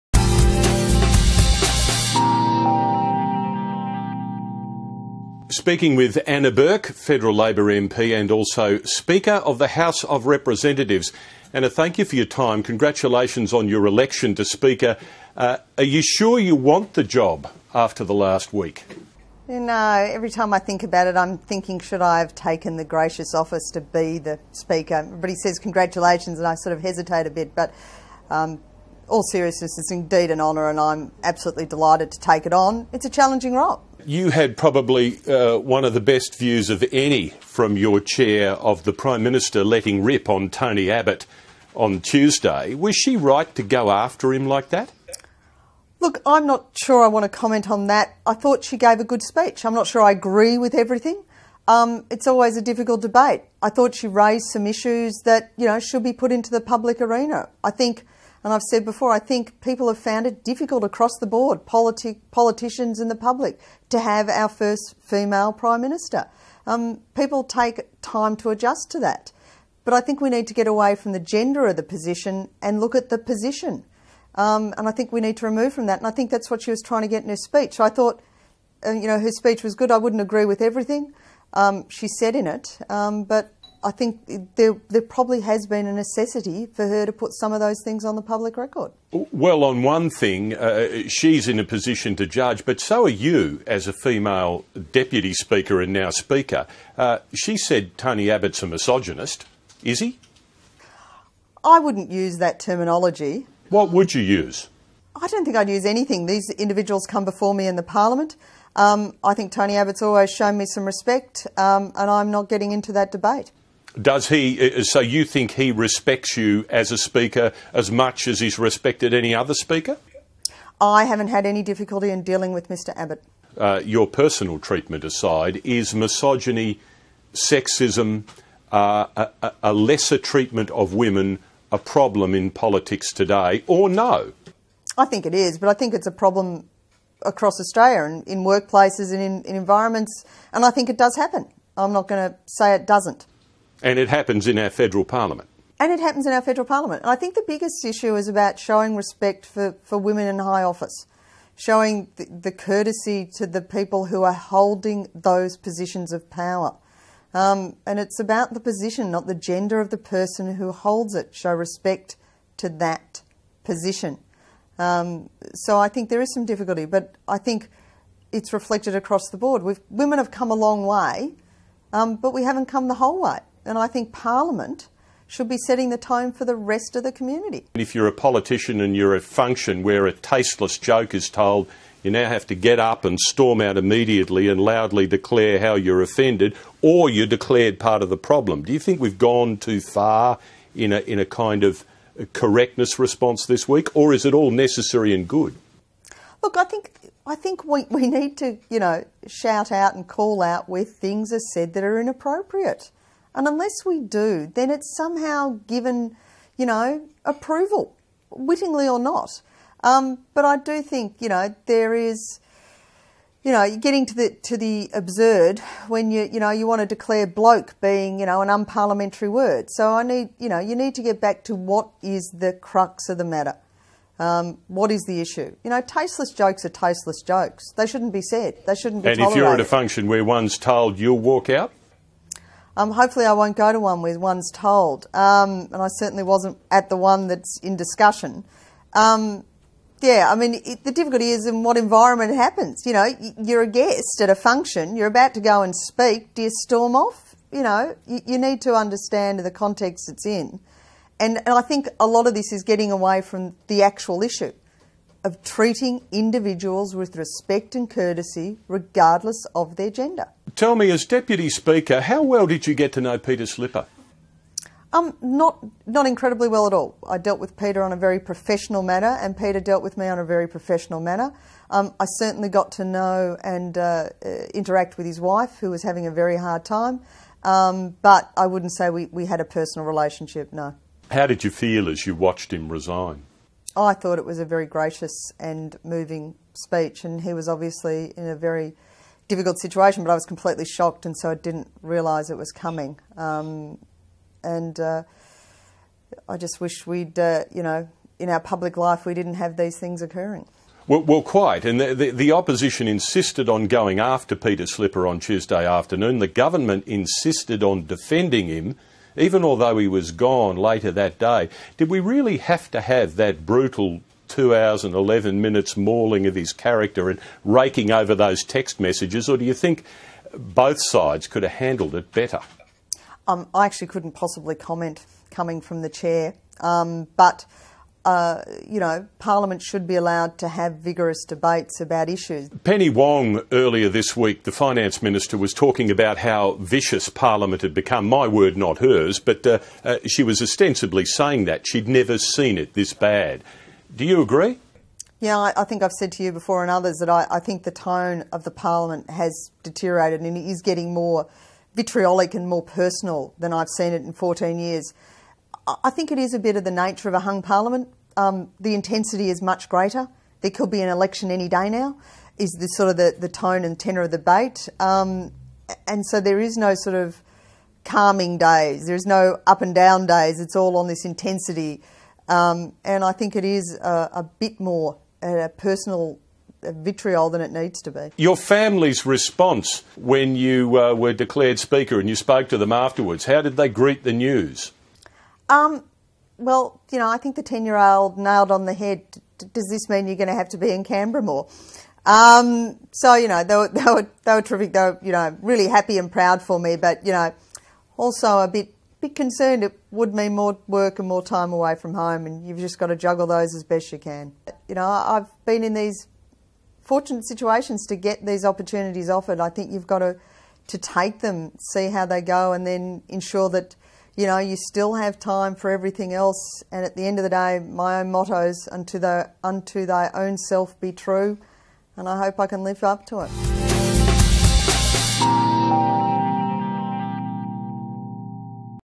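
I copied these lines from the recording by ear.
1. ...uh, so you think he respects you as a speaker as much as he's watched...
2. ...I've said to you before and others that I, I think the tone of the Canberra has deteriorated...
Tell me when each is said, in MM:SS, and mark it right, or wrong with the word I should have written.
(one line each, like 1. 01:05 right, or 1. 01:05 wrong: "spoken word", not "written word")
1. 01:54 wrong: "respected", not "watched"
2. 05:45 wrong: "Parliament", not "Canberra".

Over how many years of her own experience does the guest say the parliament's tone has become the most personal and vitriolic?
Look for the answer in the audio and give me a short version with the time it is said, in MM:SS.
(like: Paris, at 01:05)
14 years, at 05:54.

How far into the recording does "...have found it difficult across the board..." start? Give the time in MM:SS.
00:59.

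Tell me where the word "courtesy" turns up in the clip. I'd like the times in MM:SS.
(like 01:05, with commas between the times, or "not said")
02:32, 04:17.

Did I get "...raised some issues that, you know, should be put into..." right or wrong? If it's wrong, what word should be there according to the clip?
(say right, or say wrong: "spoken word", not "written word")
right.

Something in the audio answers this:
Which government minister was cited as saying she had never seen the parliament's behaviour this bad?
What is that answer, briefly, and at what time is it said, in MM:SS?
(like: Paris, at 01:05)
Penny Wong, at 05:32.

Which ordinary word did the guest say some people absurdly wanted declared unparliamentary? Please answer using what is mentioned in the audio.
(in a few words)
bloke.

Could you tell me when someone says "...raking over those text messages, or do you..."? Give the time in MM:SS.
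05:17.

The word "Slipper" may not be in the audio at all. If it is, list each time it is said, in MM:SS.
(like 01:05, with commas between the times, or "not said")
04:23, 05:04.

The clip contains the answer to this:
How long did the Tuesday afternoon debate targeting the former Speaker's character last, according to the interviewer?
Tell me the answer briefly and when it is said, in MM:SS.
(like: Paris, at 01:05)
2 hours and 11 minutes, at 05:14.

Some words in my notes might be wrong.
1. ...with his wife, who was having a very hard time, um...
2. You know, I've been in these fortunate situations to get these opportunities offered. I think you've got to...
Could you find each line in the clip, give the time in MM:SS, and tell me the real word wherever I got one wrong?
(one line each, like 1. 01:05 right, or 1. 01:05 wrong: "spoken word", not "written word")
1. 04:34 right
2. 06:44 right.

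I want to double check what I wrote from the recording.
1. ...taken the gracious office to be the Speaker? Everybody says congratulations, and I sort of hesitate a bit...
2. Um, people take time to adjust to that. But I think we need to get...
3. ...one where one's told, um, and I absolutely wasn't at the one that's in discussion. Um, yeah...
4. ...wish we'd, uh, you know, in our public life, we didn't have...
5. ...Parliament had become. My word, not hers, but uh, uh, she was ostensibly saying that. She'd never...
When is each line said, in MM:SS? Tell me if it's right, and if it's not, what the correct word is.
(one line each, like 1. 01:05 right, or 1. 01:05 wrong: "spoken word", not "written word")
1. 00:22 right
2. 01:06 right
3. 03:53 wrong: "certainly", not "absolutely"
4. 04:56 right
5. 05:37 right.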